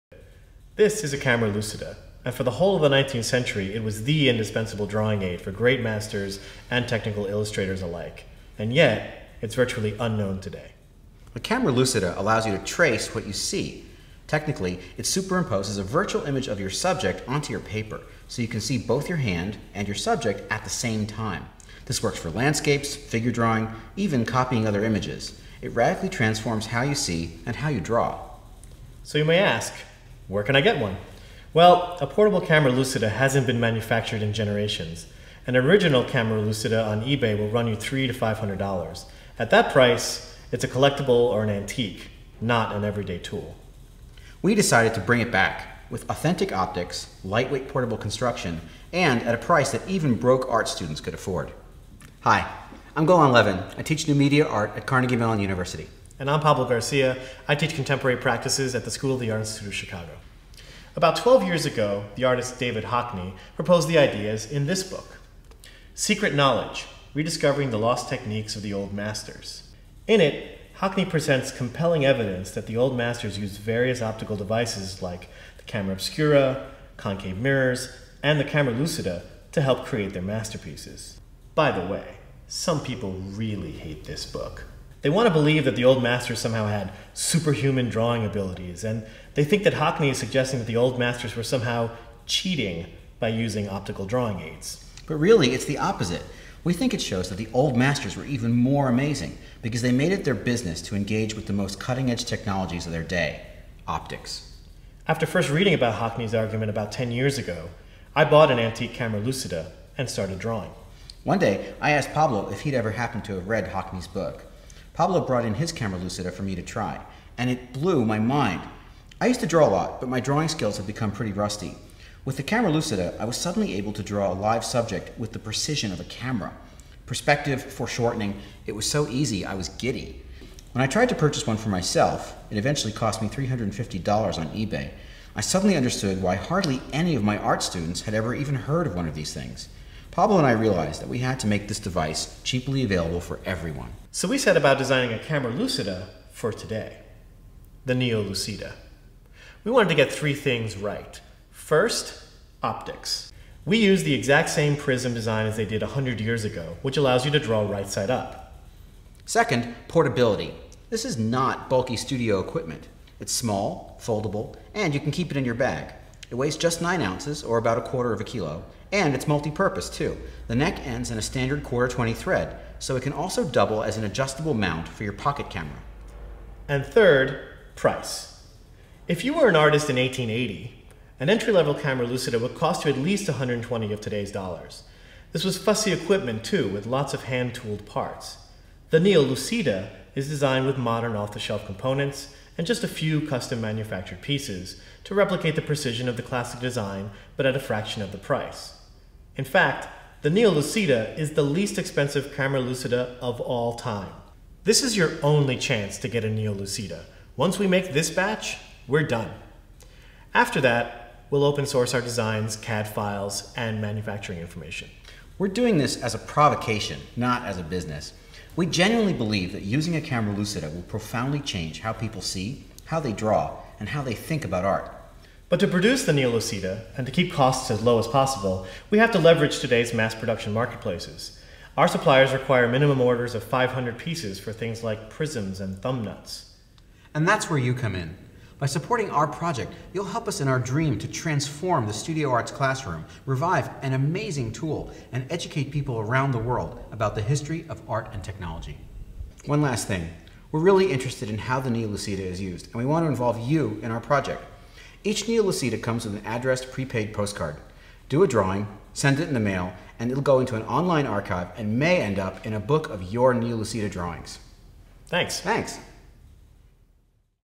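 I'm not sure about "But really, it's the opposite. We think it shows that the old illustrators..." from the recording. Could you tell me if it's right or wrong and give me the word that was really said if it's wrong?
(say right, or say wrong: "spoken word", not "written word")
wrong: "masters", not "illustrators".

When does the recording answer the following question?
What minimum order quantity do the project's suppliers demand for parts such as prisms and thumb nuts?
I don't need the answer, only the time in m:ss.
3:53.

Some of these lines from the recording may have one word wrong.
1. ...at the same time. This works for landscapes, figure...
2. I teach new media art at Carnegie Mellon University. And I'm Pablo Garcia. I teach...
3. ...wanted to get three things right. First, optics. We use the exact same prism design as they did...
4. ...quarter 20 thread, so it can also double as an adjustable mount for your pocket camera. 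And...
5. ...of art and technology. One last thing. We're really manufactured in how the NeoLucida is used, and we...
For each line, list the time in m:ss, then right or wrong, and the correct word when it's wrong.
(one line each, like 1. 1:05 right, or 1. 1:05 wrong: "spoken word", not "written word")
1. 0:20 right
2. 0:53 right
3. 2:29 right
4. 2:51 right
5. 4:07 wrong: "interested", not "manufactured".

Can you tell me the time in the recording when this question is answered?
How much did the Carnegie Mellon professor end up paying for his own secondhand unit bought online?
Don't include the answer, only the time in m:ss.
2:13.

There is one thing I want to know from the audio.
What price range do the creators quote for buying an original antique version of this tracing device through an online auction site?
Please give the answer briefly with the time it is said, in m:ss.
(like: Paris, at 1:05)
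300 to 500 dollars, at 0:37.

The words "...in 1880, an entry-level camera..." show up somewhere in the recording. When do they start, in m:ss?
2:59.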